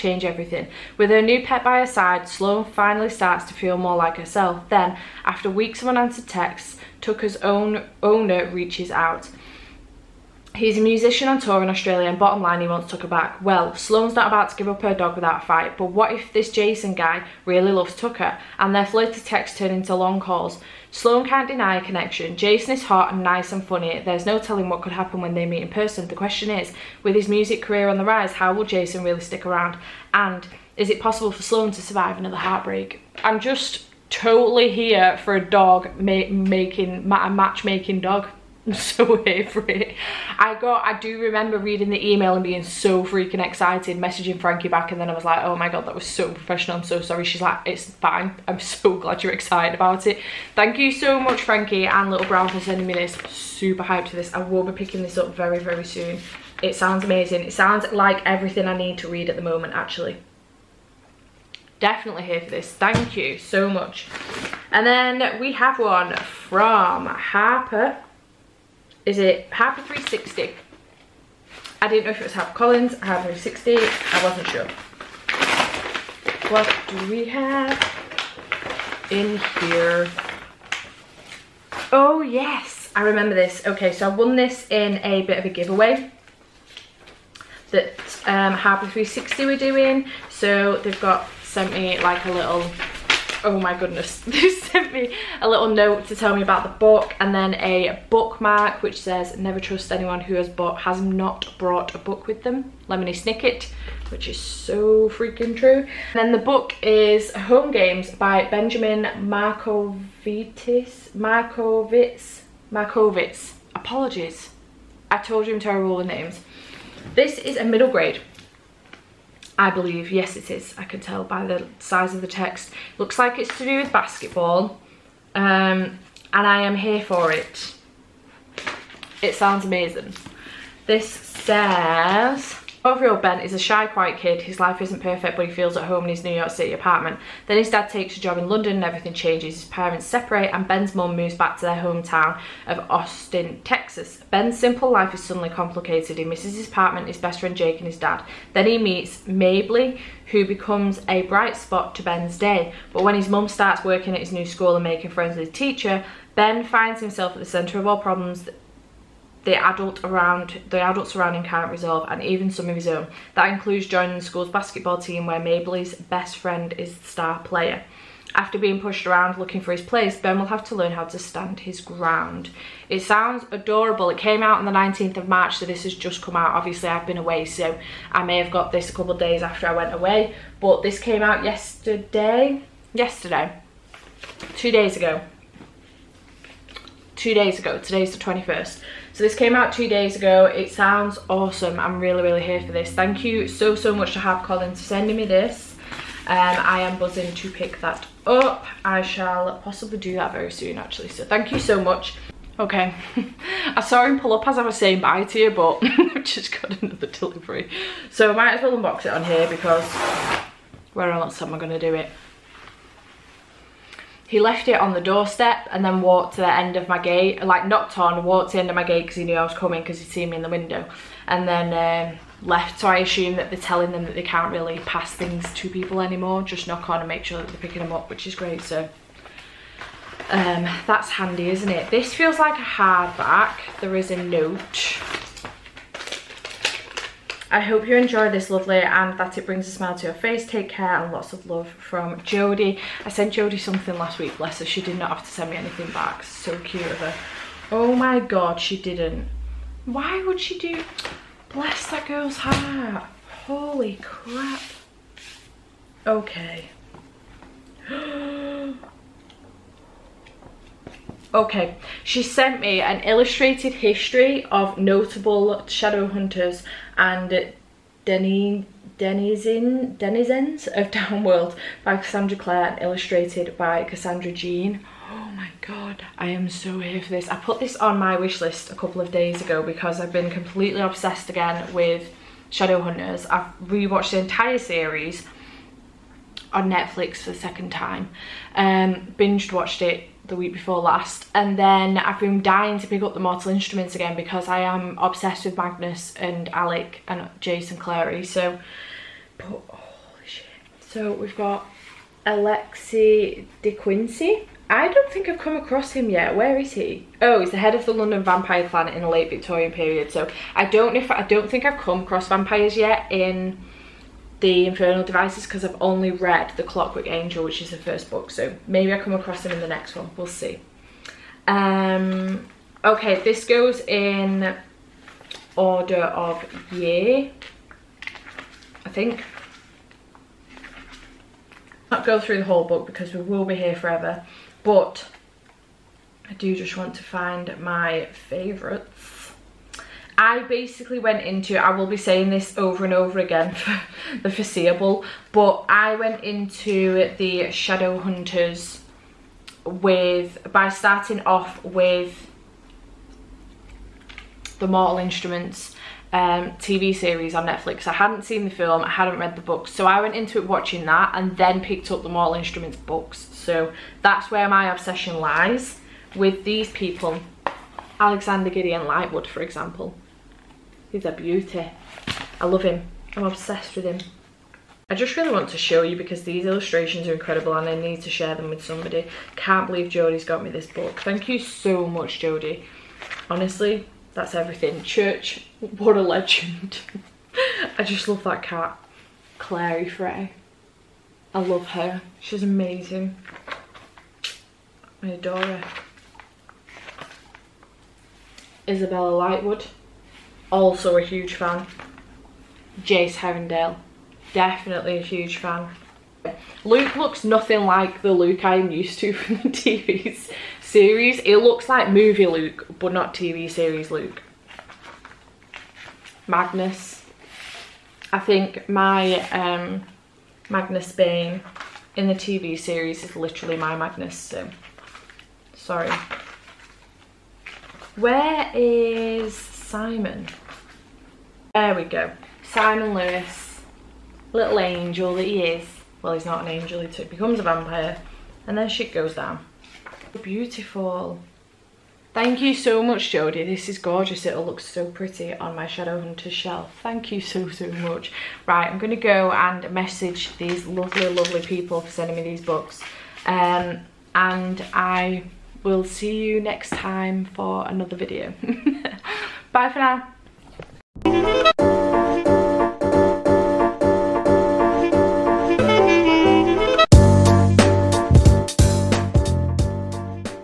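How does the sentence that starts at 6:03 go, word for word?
So that's where my obsession lies with these people Alexander Gideon Lightwood, for example.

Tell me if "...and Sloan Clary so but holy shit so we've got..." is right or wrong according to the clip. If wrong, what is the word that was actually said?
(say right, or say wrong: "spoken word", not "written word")
wrong: "Jason", not "Sloan".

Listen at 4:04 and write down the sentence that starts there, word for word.
She did not have to send me anything back.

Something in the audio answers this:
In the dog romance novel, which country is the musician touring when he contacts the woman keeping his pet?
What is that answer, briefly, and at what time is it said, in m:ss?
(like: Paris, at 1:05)
Australia, at 0:11.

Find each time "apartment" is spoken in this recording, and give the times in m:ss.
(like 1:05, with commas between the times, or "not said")
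2:16, 2:26.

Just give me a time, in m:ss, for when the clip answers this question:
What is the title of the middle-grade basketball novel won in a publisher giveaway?
1:47.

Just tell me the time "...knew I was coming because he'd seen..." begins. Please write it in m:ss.
3:39.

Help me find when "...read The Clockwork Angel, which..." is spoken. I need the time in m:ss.
5:16.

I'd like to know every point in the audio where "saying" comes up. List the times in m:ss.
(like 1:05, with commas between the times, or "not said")
3:24, 5:41.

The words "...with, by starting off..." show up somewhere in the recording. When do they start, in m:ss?
5:49.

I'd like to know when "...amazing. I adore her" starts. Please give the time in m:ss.
6:32.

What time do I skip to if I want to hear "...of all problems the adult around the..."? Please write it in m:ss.
2:37.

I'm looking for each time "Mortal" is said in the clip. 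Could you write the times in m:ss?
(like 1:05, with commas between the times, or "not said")
4:53, 5:54, 6:02.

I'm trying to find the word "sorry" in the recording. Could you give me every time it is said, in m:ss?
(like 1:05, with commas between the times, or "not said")
0:46, 7:05.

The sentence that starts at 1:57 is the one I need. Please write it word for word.
This is a middle grade I believe, yes it is, I can tell by the size of the text.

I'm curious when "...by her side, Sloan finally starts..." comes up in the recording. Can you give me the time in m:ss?
0:01.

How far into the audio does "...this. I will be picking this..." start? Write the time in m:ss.
0:54.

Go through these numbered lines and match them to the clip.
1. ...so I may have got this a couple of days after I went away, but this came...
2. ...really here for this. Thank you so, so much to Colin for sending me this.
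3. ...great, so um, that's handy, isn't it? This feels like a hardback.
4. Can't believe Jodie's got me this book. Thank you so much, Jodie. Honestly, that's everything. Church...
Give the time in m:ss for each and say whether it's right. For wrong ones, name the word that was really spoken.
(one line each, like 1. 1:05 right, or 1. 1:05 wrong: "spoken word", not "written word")
1. 2:57 right
2. 3:12 right
3. 3:48 right
4. 6:19 right.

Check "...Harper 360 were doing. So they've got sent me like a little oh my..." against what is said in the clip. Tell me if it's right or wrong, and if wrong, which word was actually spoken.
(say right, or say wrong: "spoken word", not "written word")
right.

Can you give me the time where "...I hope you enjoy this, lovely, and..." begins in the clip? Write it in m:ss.
3:57.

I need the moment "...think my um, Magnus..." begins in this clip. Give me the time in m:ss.
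6:58.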